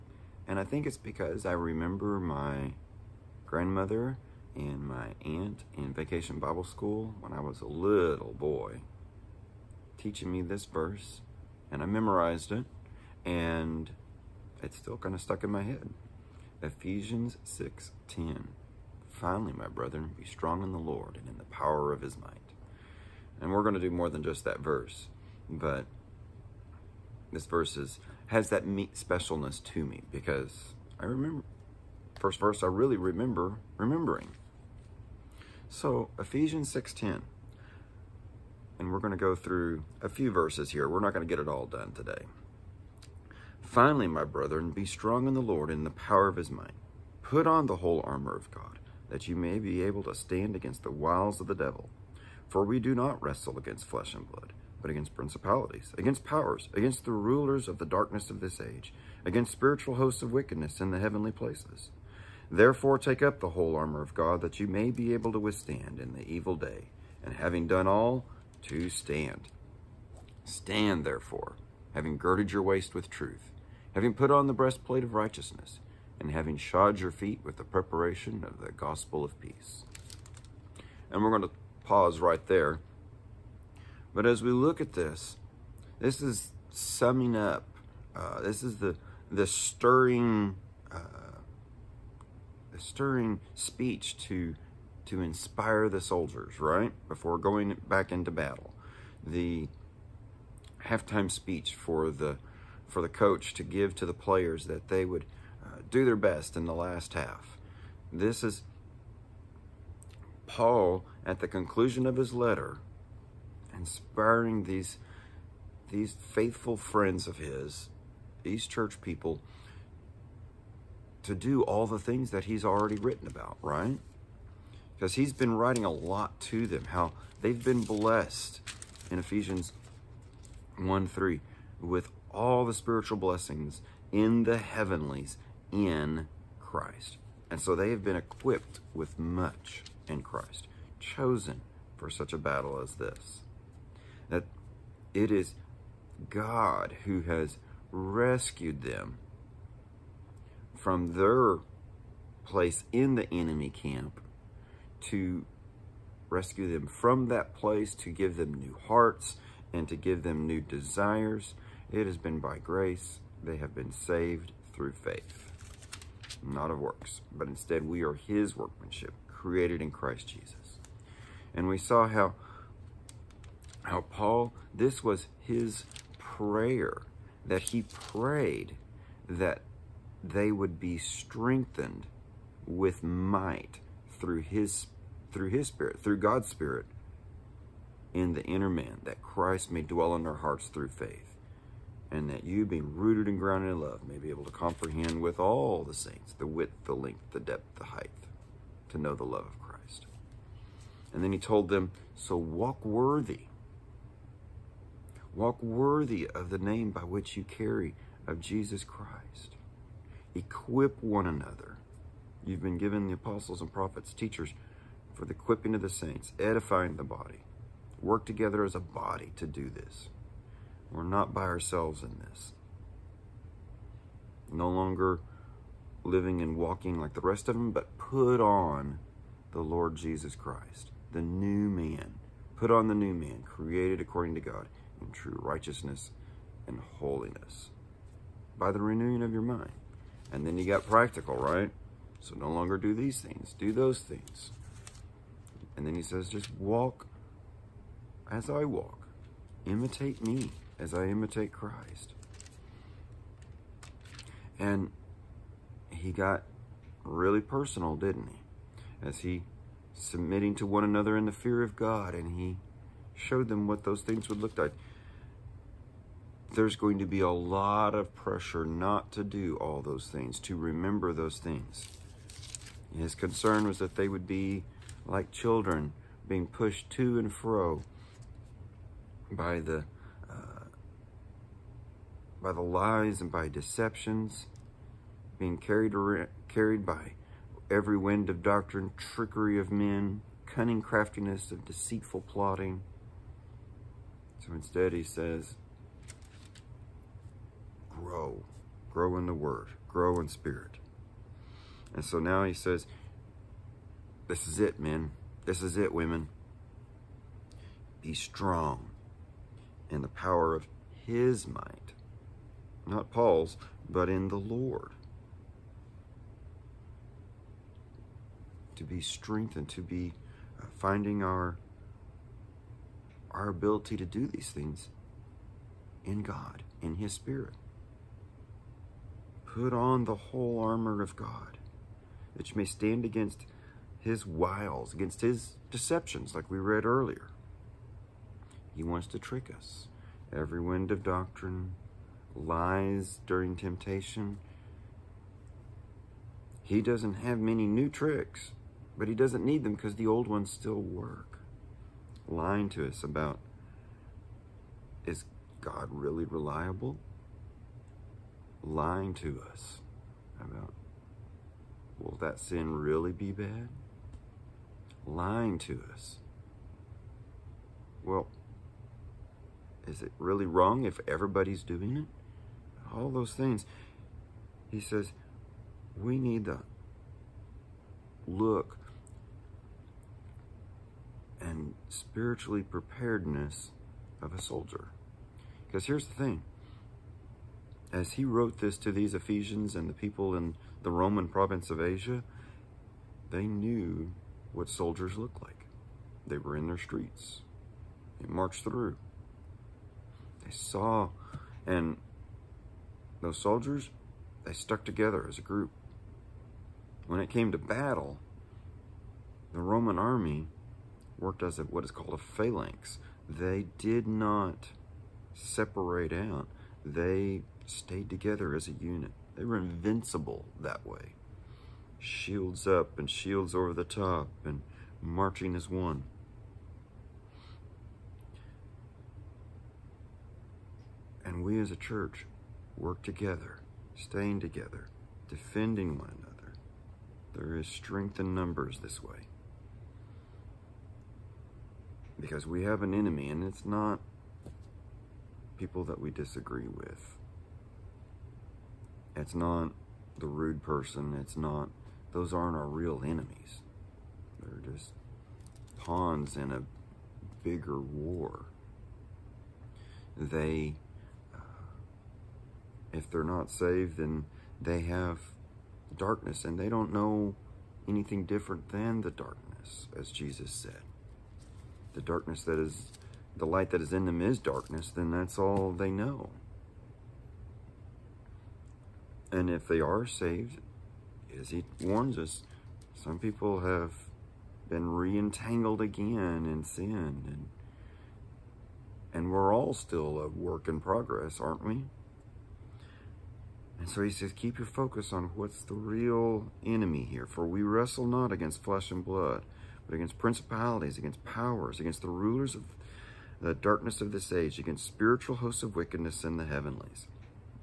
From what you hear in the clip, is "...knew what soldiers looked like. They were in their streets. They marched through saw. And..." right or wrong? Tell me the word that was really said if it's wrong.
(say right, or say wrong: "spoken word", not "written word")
right.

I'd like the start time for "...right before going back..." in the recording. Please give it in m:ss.
1:36.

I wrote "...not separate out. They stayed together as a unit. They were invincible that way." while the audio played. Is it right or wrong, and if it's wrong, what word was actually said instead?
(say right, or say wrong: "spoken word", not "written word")
right.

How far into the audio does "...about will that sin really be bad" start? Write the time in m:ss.
6:00.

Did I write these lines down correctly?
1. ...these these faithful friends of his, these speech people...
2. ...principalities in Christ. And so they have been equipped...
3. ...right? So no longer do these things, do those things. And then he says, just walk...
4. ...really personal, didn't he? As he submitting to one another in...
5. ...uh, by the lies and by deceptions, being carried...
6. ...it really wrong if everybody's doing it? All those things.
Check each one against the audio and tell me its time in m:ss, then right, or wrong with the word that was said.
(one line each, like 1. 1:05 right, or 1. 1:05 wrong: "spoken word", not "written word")
1. 1:54 wrong: "church", not "speech"
2. 2:14 wrong: "heavenlies", not "principalities"
3. 4:01 right
4. 4:17 right
5. 4:40 right
6. 6:10 right.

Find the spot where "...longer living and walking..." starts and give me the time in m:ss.
3:44.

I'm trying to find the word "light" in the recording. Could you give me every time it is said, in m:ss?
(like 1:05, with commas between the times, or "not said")
7:53.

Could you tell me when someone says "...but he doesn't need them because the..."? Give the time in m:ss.
5:48.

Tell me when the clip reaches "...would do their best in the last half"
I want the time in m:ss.
1:45.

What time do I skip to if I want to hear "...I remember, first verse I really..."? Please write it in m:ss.
0:30.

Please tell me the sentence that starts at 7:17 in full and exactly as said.
There is strength in numbers this way.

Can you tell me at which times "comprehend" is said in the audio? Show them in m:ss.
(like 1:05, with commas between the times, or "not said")
3:14.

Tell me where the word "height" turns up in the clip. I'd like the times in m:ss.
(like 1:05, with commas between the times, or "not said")
3:17.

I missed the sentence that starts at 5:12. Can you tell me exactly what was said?
Not Paul's, but in the Lord.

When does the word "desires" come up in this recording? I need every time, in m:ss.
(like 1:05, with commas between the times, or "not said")
2:40.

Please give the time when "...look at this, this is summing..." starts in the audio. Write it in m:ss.
1:24.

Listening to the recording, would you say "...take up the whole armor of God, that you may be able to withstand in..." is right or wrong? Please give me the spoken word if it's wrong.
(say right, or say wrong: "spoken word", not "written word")
right.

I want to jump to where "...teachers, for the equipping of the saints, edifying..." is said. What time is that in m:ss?
3:34.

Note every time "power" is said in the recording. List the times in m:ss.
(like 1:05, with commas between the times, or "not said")
0:21, 0:45, 0:56, 5:10, 8:21.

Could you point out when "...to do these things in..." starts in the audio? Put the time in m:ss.
5:23.